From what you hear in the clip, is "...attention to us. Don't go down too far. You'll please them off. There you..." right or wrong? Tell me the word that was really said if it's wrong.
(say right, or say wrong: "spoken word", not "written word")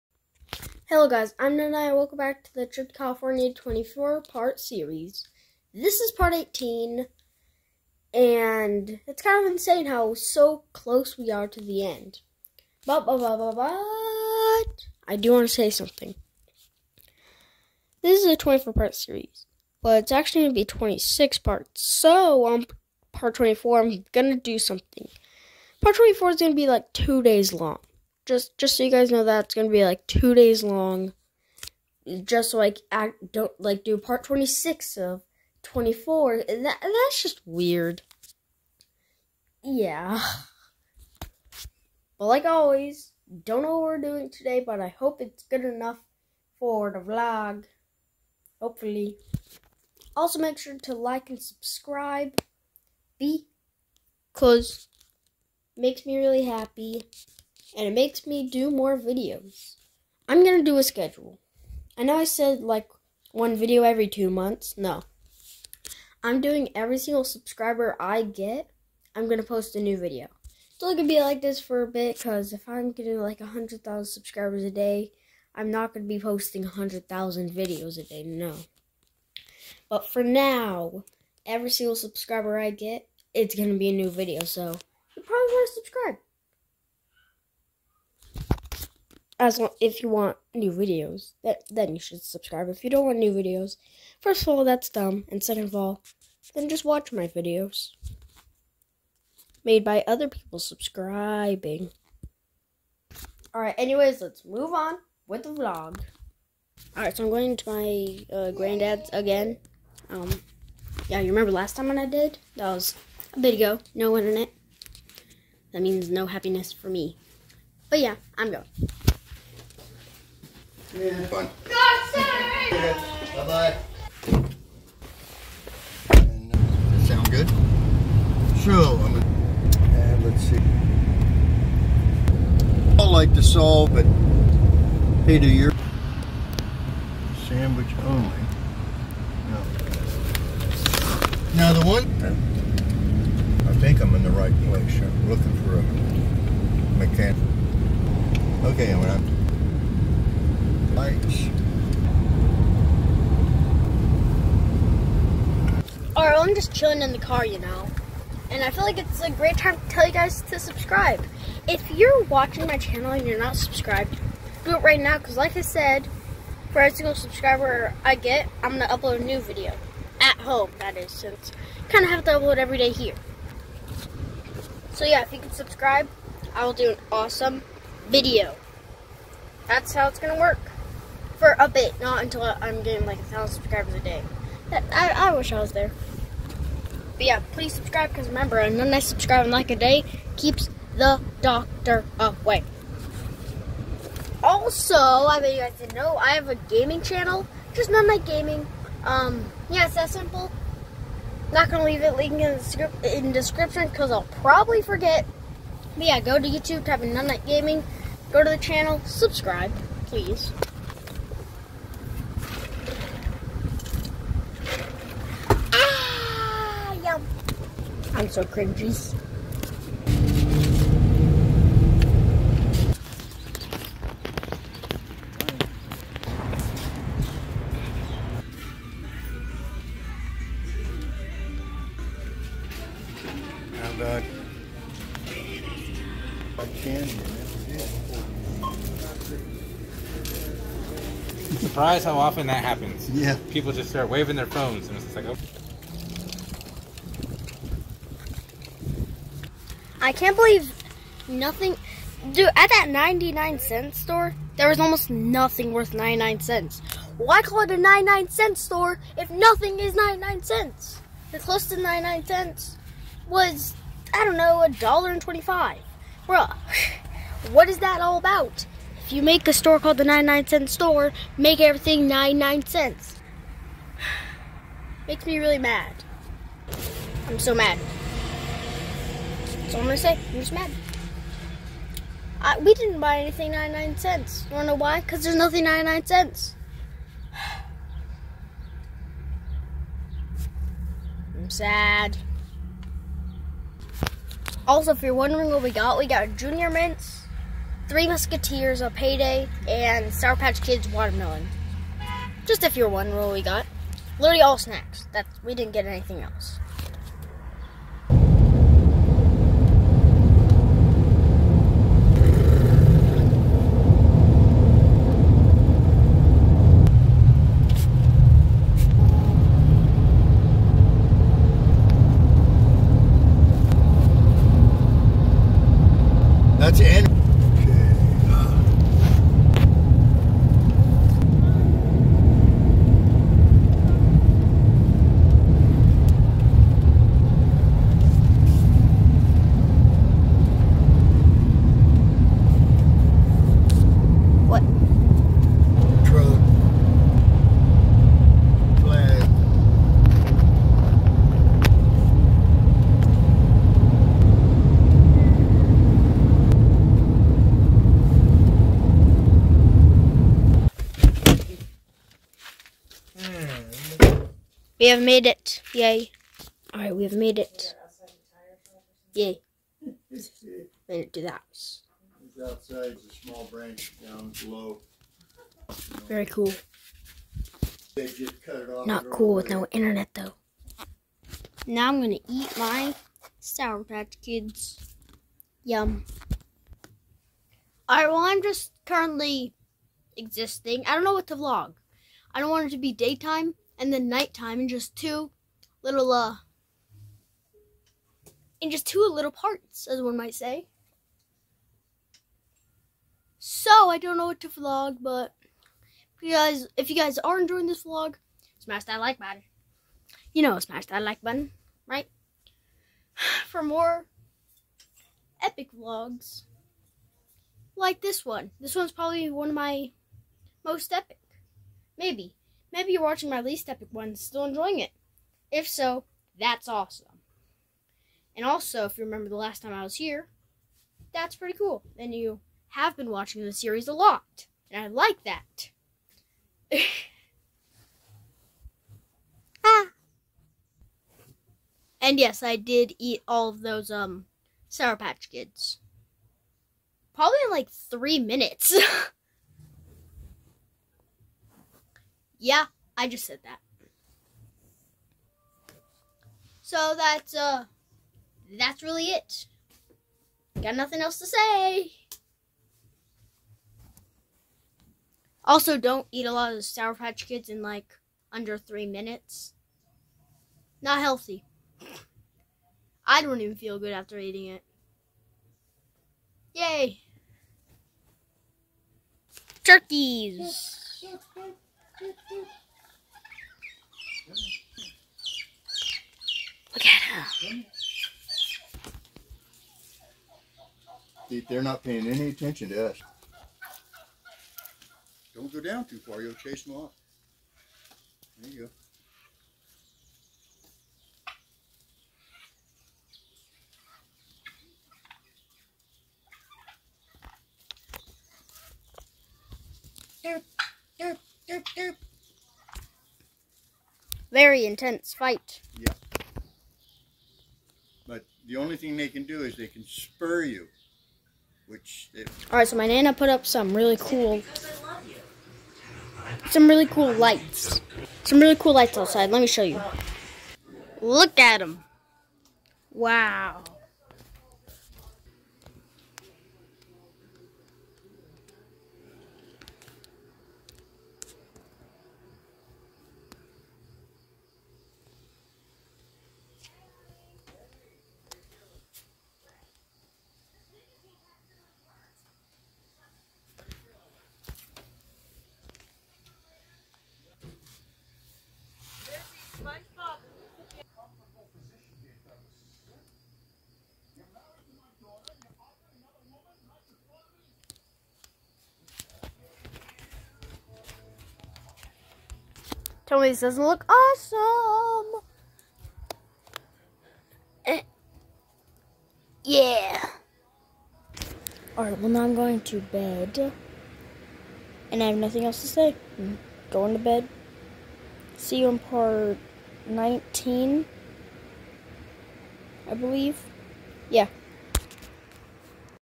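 wrong: "chase", not "please".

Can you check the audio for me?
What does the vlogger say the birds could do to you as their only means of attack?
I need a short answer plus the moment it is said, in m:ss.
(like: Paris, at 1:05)
spur you, at 8:39.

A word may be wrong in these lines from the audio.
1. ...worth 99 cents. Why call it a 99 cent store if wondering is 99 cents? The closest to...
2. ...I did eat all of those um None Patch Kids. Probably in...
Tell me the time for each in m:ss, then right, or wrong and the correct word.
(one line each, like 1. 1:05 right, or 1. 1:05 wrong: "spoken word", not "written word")
1. 4:15 wrong: "nothing", not "wondering"
2. 7:22 wrong: "Sour", not "None".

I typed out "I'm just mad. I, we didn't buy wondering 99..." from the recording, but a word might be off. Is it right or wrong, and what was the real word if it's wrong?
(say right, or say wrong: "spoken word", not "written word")
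wrong: "anything", not "wondering".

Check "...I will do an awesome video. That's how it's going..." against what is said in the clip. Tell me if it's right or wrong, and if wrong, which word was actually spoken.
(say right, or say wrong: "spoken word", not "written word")
right.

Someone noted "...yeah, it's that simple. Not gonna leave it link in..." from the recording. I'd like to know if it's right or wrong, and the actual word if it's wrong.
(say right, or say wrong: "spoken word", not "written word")
right.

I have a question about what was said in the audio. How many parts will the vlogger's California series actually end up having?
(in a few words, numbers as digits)
26.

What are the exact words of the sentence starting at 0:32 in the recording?
Just so like act don't like do part twenty six of twenty four.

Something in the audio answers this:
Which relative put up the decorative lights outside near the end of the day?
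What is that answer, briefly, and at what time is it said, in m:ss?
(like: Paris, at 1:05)
Nana, at 8:42.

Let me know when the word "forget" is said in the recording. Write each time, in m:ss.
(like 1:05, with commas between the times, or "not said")
3:24.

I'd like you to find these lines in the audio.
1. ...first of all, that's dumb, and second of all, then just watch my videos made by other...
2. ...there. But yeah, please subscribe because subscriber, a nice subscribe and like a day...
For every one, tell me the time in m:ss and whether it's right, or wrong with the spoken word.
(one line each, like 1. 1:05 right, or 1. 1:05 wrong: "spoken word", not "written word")
1. 1:34 right
2. 3:05 wrong: "remember", not "subscriber".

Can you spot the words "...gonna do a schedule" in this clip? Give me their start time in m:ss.
1:00.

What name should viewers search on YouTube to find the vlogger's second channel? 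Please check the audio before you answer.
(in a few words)
None Gaming.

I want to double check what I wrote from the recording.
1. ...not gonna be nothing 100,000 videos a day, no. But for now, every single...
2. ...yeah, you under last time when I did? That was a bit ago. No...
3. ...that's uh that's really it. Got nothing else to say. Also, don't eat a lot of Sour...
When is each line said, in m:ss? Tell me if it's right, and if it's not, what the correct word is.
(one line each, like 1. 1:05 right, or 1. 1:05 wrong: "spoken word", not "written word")
1. 1:15 wrong: "posting", not "nothing"
2. 1:51 wrong: "remember", not "under"
3. 7:36 right.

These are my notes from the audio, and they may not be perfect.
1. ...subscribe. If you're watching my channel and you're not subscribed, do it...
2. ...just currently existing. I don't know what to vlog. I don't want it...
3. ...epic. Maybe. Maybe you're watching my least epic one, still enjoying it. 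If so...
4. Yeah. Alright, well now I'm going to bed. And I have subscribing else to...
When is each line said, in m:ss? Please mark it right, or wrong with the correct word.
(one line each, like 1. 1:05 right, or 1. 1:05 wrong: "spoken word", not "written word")
1. 2:40 right
2. 6:28 right
3. 7:00 right
4. 9:39 wrong: "nothing", not "subscribing".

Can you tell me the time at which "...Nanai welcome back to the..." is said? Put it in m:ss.
0:01.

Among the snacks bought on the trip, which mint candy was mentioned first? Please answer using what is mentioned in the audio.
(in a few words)
Junior Mints.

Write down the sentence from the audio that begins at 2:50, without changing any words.
At home, that is, since I kind of have to upload every day here.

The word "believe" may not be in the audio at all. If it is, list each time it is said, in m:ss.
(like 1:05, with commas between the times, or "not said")
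4:10, 9:52.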